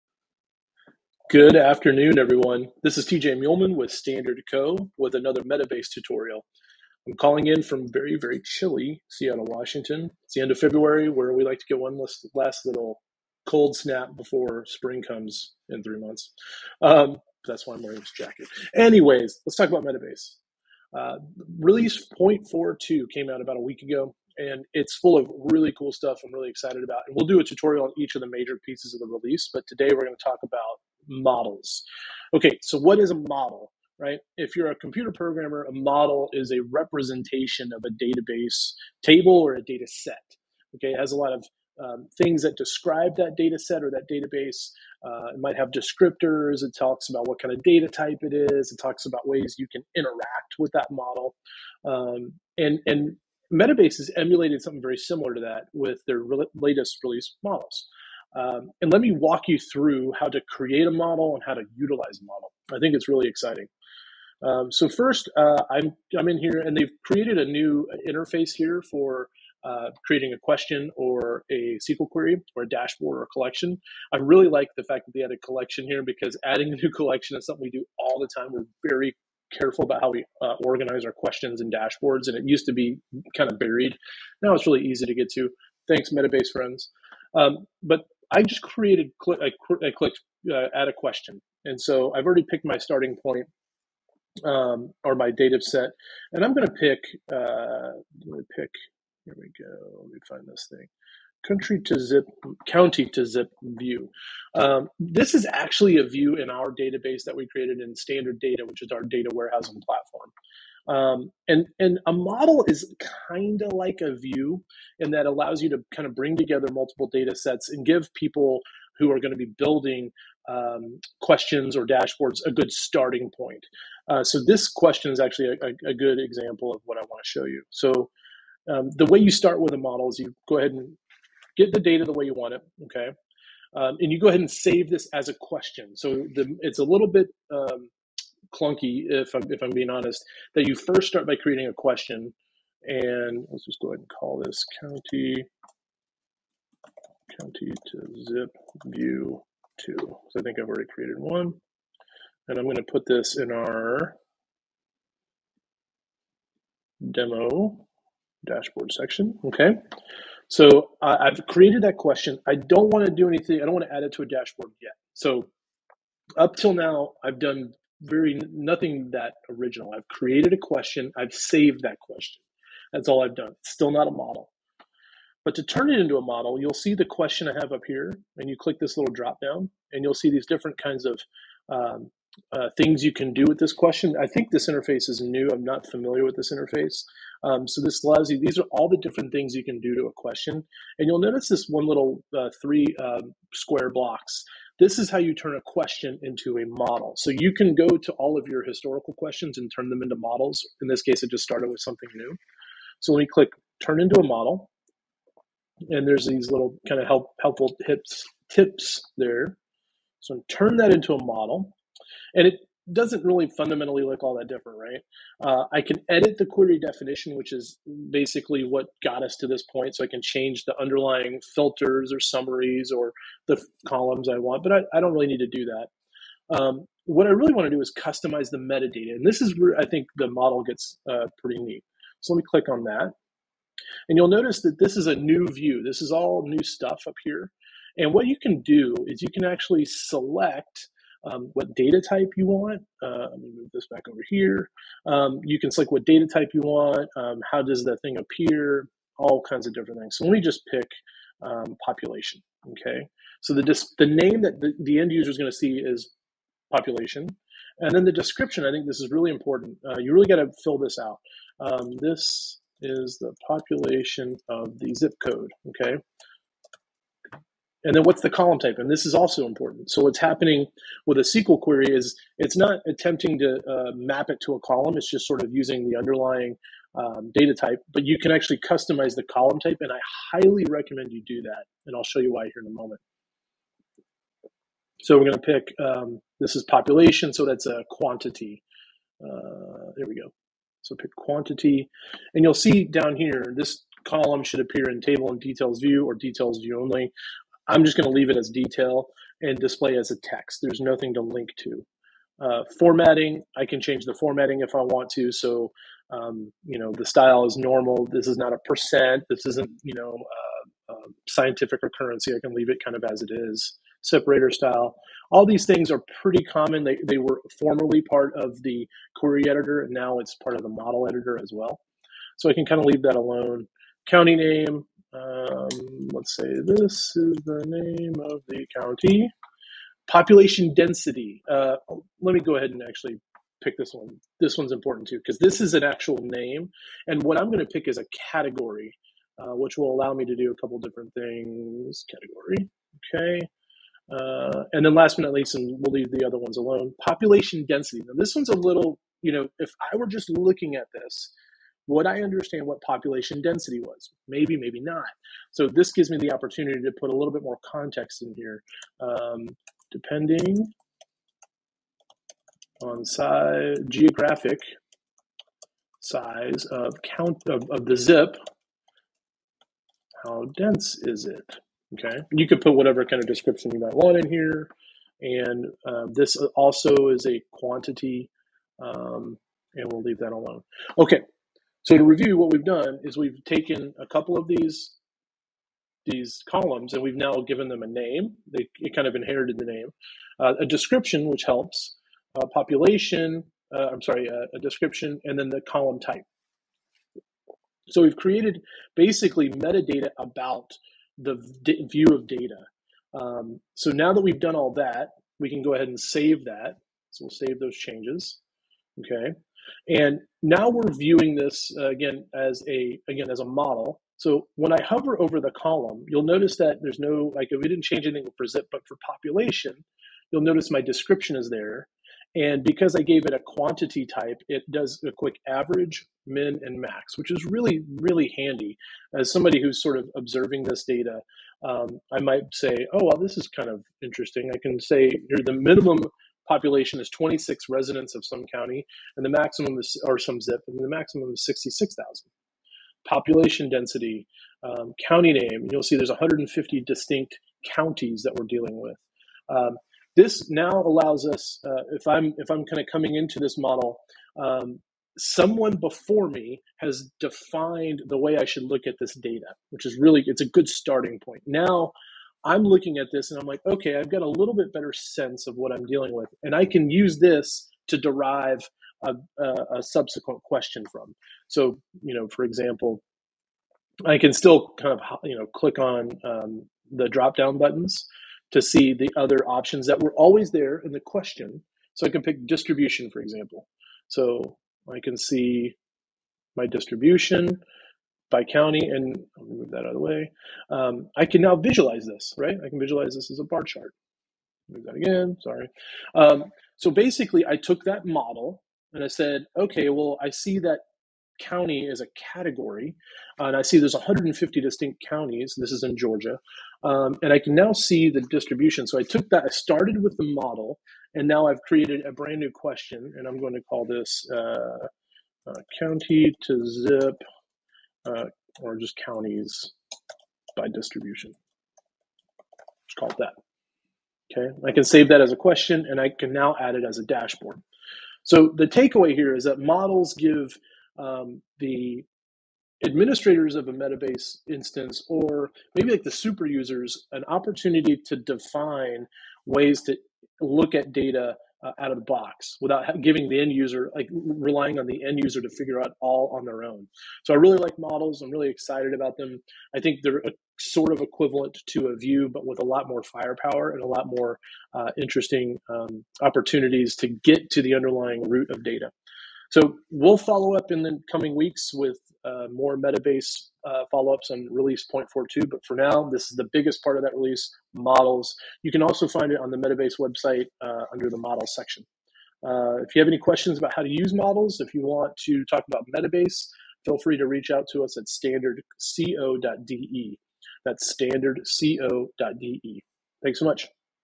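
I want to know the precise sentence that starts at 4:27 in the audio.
And then what's the column type?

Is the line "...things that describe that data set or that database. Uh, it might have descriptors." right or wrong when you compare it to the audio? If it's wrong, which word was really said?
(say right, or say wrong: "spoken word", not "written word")
right.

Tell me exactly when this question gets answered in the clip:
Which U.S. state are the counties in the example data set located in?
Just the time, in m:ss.
8:25.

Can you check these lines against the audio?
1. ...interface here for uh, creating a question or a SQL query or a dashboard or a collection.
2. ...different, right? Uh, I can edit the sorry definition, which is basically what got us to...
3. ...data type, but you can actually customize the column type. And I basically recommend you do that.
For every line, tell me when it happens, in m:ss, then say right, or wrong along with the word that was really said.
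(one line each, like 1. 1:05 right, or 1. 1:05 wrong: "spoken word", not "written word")
1. 1:08 right
2. 3:34 wrong: "query", not "sorry"
3. 4:37 wrong: "highly", not "basically".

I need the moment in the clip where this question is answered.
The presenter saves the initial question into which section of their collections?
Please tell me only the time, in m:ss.
2:37.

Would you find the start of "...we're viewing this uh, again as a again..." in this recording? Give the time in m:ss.
6:50.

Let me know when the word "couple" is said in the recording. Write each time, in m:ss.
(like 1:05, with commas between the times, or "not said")
5:40, 6:24.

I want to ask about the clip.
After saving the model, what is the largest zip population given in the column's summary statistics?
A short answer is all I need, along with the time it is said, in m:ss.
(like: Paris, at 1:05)
66,000, at 7:21.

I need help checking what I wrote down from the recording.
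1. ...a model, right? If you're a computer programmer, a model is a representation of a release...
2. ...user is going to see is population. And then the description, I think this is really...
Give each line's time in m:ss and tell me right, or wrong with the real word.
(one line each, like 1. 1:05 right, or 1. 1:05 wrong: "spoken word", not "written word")
1. 0:33 wrong: "database", not "release"
2. 4:15 right.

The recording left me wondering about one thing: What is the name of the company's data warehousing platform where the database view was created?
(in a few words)
Standard Data.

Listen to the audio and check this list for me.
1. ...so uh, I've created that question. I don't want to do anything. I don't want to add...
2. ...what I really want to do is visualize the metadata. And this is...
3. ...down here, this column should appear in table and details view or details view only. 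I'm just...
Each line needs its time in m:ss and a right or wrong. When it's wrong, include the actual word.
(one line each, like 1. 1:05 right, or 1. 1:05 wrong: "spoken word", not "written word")
1. 2:40 right
2. 3:47 wrong: "customize", not "visualize"
3. 4:52 right.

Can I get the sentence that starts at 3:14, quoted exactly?
This is how you turn a question into a model.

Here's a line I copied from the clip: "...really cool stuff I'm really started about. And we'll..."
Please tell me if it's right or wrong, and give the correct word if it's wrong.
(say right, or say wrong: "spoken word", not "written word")
wrong: "excited", not "started".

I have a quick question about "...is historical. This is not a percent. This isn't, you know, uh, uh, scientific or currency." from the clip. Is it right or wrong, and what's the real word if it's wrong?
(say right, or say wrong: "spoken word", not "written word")
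wrong: "normal", not "historical".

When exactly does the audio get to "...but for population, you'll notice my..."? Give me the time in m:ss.
6:58.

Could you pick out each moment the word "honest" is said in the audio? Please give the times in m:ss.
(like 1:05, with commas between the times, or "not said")
2:19.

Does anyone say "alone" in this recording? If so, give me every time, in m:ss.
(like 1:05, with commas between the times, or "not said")
5:23, 5:46, 6:20.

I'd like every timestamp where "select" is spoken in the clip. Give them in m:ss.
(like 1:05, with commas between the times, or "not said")
3:59, 4:05.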